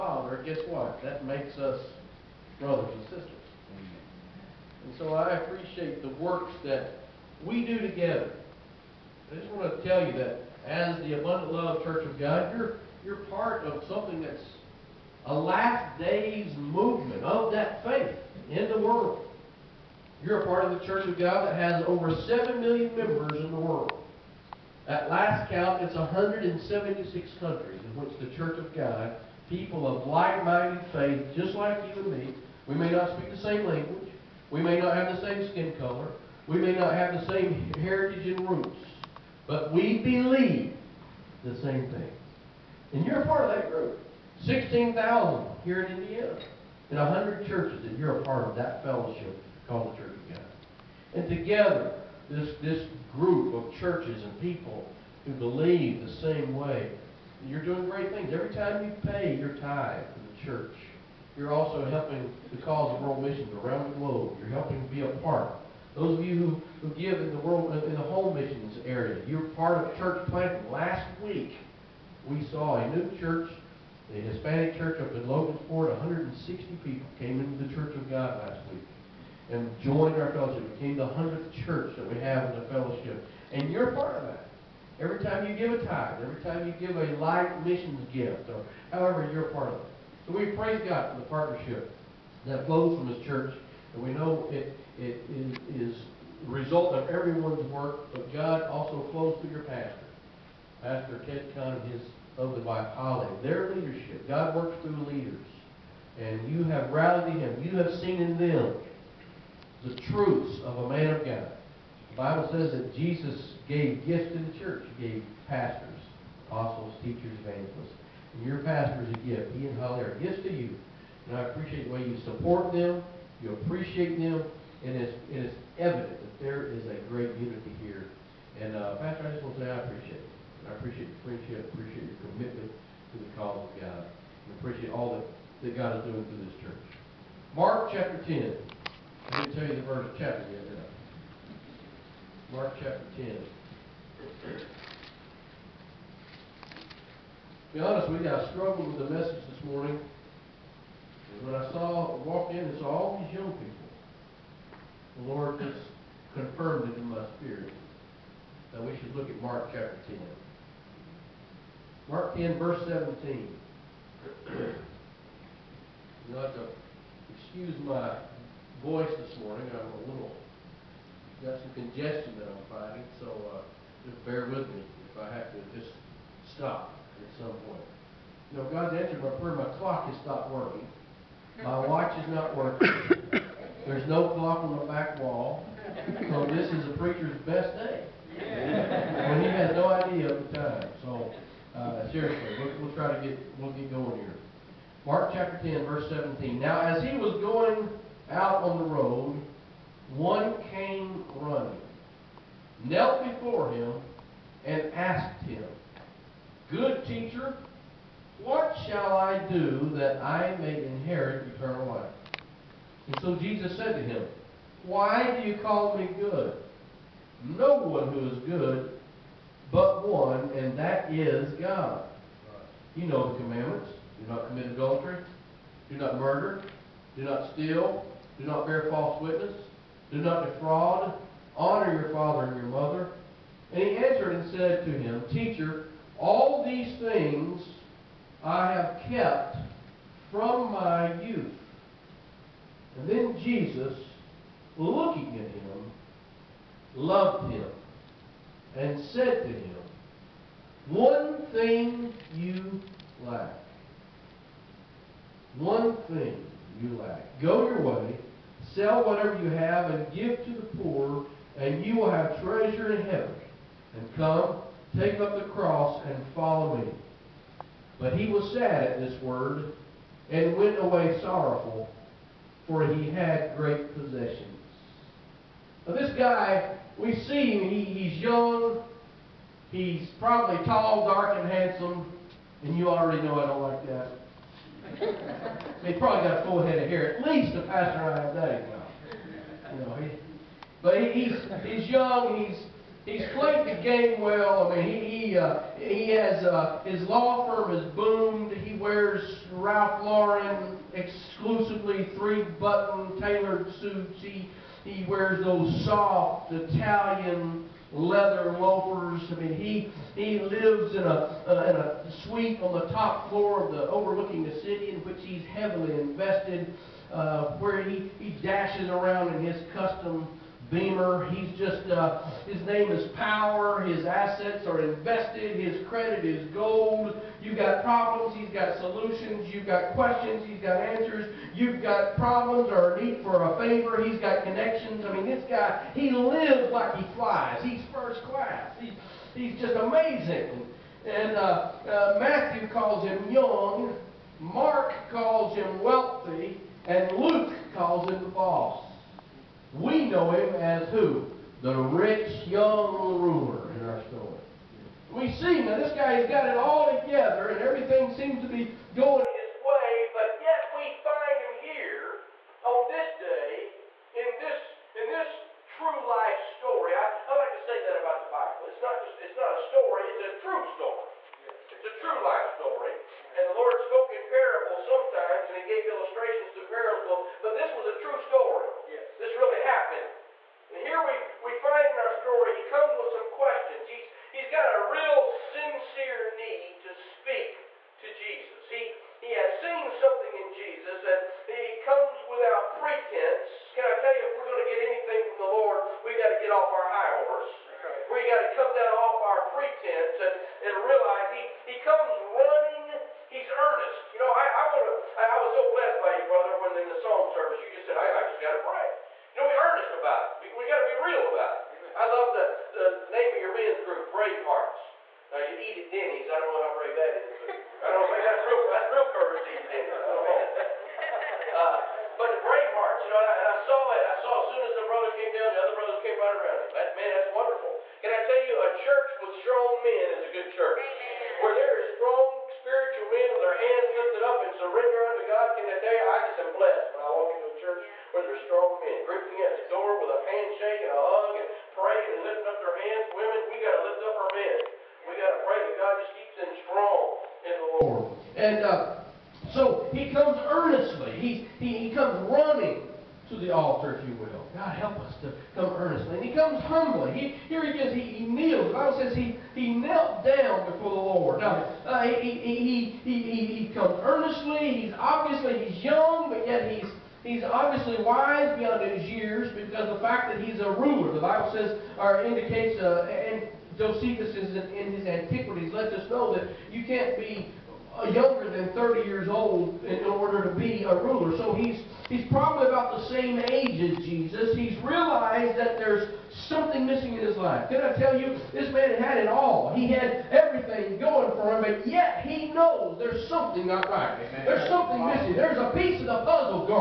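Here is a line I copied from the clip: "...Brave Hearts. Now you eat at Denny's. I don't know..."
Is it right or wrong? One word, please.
right.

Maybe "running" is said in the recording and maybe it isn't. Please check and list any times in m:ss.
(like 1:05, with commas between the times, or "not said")
3:21, 6:42, 7:32.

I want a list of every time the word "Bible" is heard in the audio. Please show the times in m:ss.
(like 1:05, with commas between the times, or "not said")
1:52, 6:08, 7:38, 7:51.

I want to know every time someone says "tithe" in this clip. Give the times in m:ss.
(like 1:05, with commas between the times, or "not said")
0:59, 1:25.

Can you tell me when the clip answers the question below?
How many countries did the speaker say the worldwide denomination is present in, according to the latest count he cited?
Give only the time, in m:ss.
0:25.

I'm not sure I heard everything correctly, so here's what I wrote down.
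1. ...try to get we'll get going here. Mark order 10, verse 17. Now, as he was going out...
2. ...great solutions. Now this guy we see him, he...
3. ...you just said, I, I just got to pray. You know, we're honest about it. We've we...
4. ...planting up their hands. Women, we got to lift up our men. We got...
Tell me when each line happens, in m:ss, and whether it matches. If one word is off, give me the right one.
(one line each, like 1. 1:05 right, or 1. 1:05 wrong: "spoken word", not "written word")
1. 3:12 wrong: "chapter", not "order"
2. 4:33 wrong: "possessions", not "solutions"
3. 6:47 wrong: "earnest", not "honest"
4. 7:22 wrong: "lifting", not "planting".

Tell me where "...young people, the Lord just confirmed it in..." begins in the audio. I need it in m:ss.
2:33.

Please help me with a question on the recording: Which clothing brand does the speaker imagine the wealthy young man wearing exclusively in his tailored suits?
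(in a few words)
Ralph Lauren.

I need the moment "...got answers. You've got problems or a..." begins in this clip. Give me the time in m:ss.
5:30.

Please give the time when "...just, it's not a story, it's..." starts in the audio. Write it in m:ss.
6:09.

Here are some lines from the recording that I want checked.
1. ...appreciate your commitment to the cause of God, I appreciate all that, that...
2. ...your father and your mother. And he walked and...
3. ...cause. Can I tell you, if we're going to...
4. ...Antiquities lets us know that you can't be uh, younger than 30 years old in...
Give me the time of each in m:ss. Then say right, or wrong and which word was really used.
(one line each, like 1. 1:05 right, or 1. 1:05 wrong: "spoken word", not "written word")
1. 2:11 right
2. 3:51 wrong: "answered", not "walked"
3. 6:32 wrong: "pretense", not "cause"
4. 7:55 right.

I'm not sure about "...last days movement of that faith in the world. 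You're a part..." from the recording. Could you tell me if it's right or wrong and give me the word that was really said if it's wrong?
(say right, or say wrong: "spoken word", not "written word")
right.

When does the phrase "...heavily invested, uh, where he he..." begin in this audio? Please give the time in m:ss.
5:15.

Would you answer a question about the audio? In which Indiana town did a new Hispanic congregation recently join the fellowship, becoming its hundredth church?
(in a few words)
Logansport.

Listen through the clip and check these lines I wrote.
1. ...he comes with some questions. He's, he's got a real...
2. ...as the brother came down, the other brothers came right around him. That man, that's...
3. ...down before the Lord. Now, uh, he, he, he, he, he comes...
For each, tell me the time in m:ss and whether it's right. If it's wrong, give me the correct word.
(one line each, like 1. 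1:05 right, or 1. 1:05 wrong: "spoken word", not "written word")
1. 6:22 right
2. 7:04 right
3. 7:40 right.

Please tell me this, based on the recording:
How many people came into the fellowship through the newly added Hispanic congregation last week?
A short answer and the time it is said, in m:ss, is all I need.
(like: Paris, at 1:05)
160, at 1:15.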